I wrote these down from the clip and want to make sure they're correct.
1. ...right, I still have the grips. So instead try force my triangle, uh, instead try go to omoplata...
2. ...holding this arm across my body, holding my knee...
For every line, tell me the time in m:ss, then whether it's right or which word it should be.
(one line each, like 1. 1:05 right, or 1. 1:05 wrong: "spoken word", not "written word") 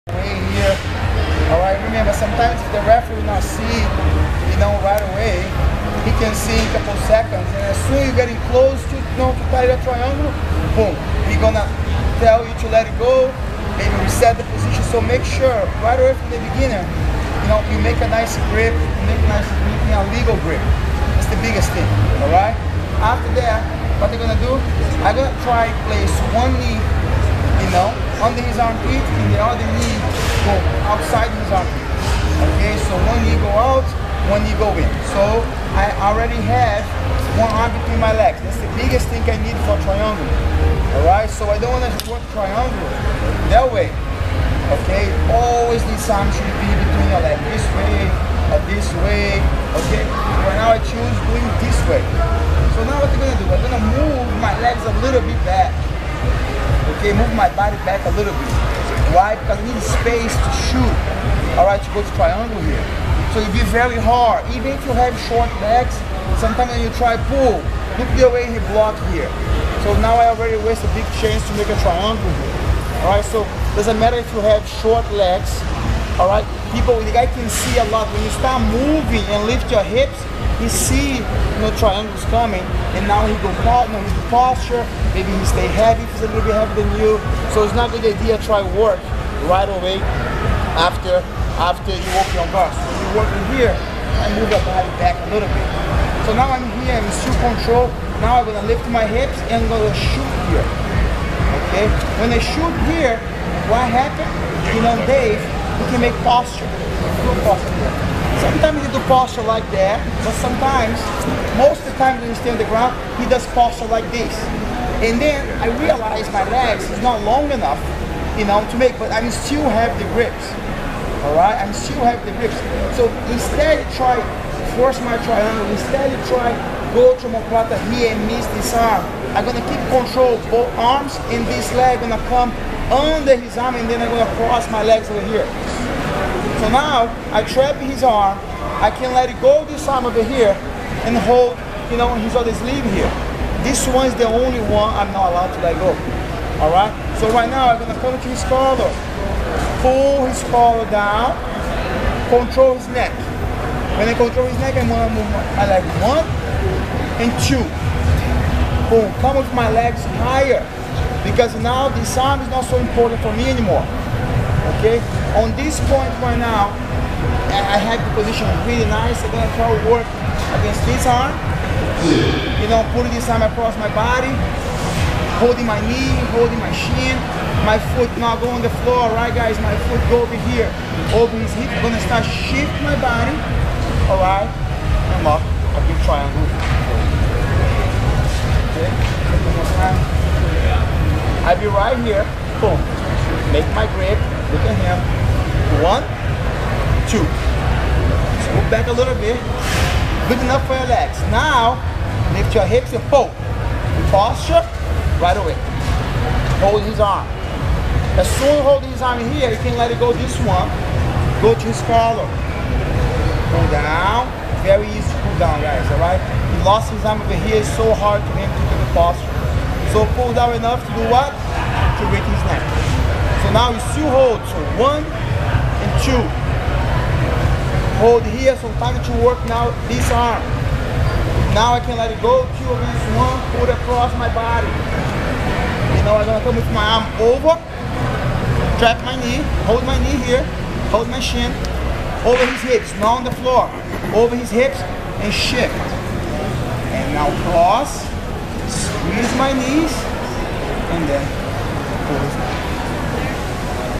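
1. 2:01 right
2. 2:52 wrong: "putting", not "holding".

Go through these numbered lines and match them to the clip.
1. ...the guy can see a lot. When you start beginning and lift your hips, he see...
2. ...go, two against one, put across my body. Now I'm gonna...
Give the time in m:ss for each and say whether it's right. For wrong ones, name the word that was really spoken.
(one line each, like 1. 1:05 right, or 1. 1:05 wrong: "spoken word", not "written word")
1. 1:17 wrong: "moving", not "beginning"
2. 3:52 right.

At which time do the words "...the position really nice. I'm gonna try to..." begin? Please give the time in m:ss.
2:48.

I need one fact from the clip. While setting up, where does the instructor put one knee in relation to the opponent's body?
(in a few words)
Under his armpit.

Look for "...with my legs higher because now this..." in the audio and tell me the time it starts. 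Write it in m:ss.
2:39.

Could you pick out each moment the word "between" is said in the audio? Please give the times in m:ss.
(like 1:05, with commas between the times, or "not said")
0:37, 0:46.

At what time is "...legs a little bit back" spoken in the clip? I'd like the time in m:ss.
0:54.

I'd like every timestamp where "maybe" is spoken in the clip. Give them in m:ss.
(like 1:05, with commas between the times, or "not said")
0:13, 1:25.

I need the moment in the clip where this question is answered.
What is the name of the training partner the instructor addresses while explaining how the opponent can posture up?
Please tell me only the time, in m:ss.
1:45.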